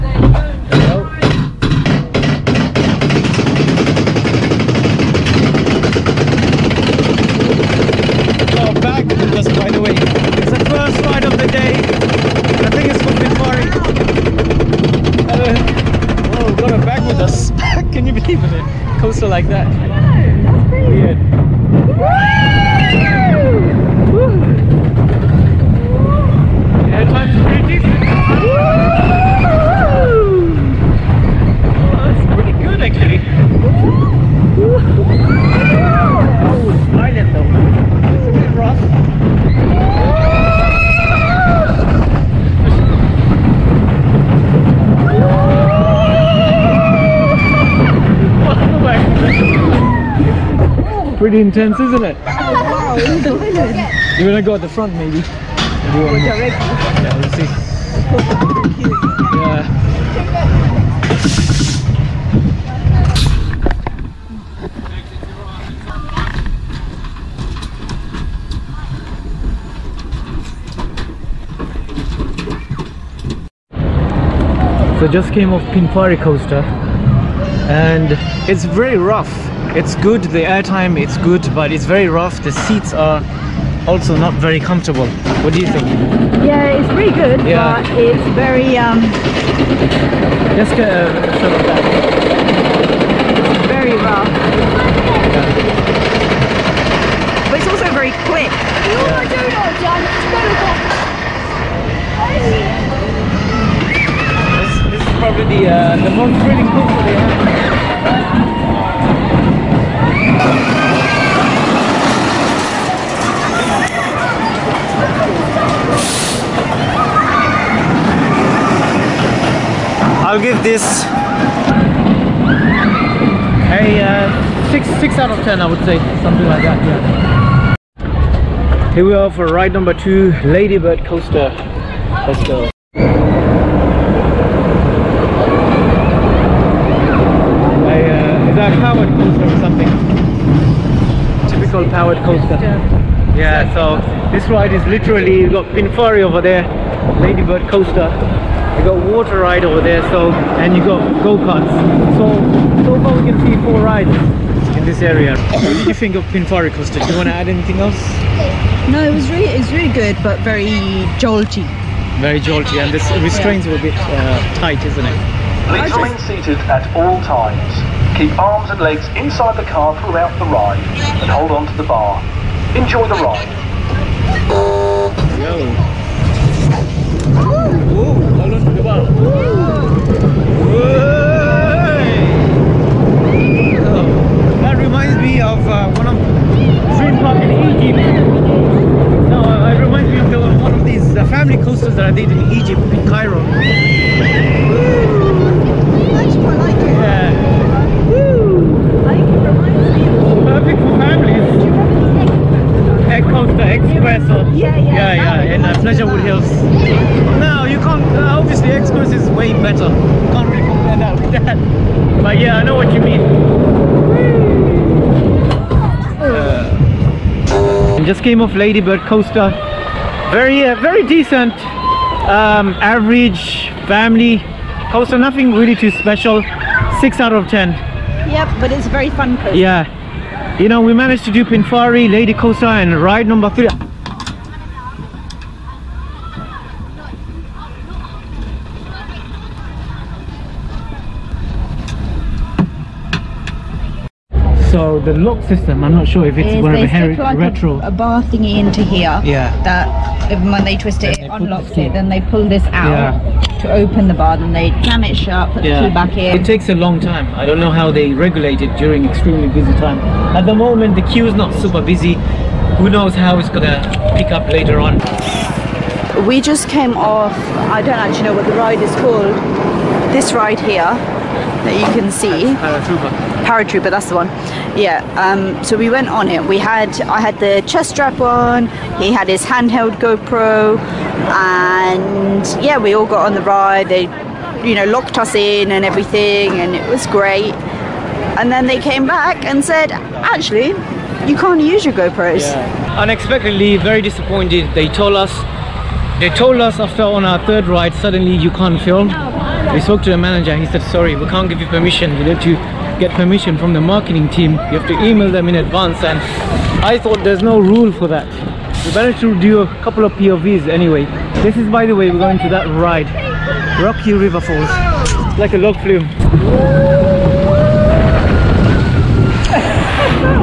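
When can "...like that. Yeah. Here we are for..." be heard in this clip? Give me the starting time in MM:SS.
02:06.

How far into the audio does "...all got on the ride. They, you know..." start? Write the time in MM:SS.
04:42.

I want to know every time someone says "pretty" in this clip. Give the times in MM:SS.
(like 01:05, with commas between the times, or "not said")
00:51, 01:26.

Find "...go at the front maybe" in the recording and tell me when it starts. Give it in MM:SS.
00:54.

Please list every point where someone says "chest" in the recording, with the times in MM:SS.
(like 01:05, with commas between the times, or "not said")
04:37.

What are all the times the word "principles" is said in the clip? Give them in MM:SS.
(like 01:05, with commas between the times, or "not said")
not said.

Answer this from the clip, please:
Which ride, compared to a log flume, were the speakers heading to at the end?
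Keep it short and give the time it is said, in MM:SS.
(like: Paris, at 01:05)
Rocky River Falls, at 05:13.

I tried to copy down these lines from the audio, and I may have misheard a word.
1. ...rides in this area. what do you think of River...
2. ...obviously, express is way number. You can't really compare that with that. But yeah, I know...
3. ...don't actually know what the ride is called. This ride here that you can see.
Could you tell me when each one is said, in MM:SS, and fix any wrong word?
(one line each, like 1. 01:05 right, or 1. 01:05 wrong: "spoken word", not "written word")
1. 02:33 wrong: "Pinfari", not "River"
2. 03:28 wrong: "better", not "number"
3. 04:27 right.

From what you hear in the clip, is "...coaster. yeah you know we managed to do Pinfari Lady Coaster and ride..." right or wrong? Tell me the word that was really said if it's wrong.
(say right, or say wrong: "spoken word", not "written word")
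right.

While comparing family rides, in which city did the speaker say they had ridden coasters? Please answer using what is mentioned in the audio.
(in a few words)
Cairo.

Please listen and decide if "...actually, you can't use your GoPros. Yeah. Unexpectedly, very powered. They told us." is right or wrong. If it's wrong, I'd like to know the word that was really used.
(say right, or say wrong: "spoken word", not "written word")
wrong: "disappointed", not "powered".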